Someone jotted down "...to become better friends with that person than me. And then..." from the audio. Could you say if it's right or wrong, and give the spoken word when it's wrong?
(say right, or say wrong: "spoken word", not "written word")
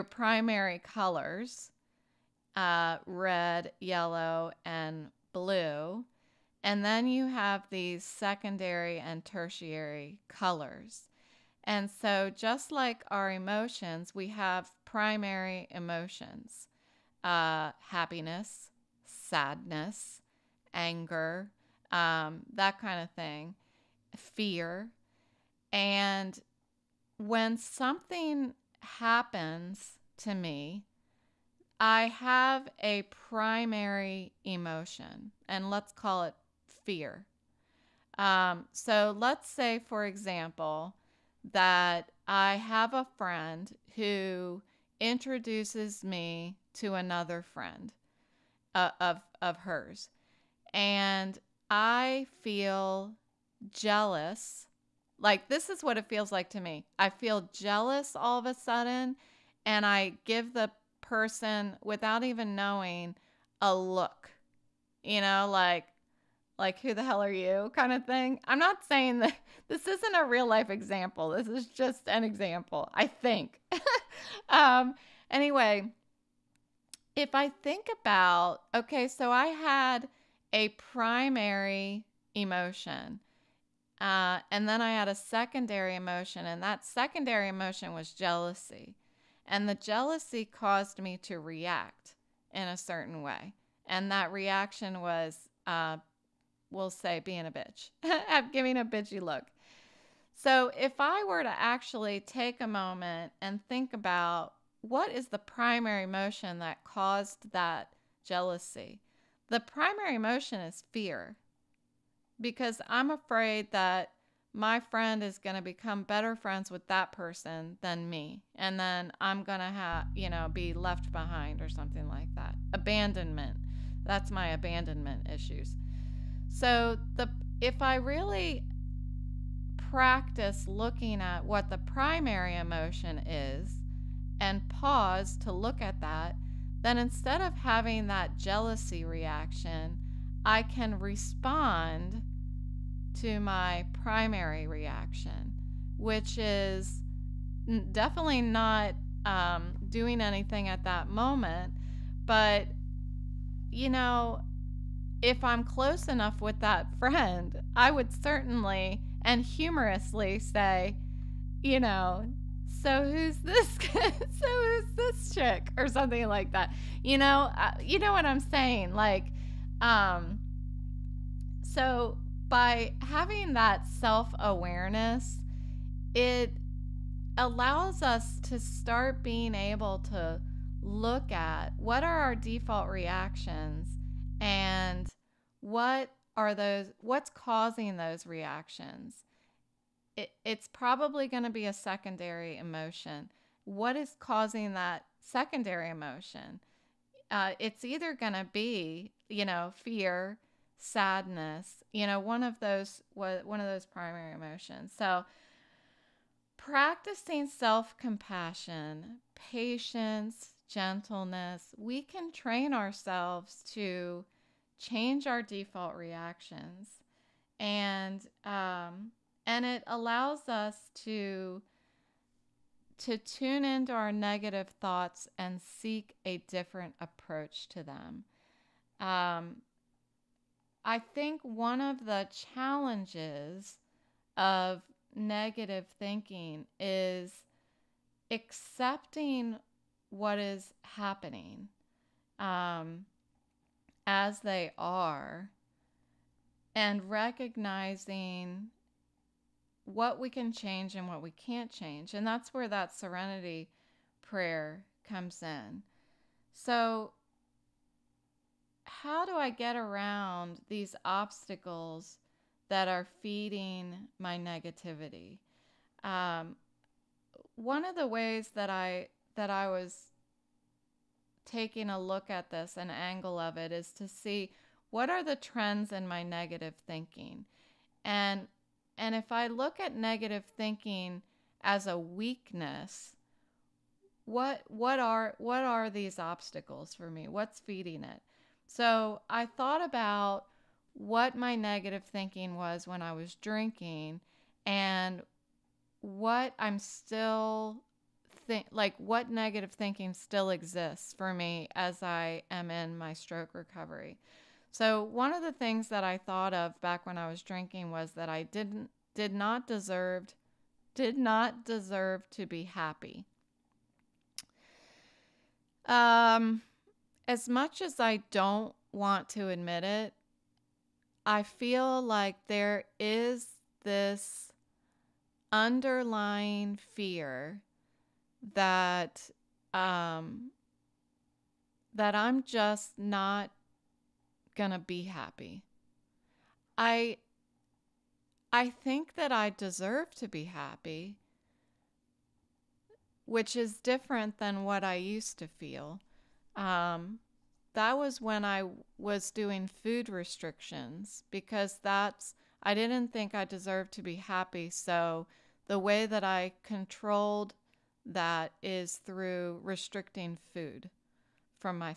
right.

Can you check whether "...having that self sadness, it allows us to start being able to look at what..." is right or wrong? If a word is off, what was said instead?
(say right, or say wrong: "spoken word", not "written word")
wrong: "awareness", not "sadness".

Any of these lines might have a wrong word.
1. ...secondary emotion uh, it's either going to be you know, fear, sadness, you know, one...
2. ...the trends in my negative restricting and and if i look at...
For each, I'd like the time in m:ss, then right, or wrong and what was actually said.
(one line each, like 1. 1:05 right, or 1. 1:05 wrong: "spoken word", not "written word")
1. 3:15 right
2. 4:35 wrong: "thinking", not "restricting".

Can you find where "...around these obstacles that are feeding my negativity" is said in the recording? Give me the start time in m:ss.
4:19.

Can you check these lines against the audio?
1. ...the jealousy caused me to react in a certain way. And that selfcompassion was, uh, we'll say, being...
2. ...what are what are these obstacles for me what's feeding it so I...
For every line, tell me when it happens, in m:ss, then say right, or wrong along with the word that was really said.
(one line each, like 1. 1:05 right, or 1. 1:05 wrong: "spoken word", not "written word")
1. 1:29 wrong: "reaction", not "selfcompassion"
2. 4:44 right.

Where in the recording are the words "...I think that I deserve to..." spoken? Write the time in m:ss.
5:38.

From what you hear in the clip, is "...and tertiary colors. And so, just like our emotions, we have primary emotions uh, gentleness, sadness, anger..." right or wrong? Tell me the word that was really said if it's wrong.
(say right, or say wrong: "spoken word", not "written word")
wrong: "happiness", not "gentleness".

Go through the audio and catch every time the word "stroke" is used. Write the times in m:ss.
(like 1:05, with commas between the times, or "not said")
5:03.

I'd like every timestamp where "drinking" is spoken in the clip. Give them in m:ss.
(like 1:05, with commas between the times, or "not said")
4:53, 5:07.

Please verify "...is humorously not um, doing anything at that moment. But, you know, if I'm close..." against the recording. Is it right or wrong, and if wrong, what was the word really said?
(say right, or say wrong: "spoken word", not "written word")
wrong: "definitely", not "humorously".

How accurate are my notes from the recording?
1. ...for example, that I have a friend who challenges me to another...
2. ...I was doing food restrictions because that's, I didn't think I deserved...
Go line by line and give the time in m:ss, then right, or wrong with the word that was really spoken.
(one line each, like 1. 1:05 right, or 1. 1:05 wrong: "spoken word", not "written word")
1. 0:39 wrong: "introduces", not "challenges"
2. 5:48 right.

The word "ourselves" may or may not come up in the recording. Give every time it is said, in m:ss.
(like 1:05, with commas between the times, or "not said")
3:32.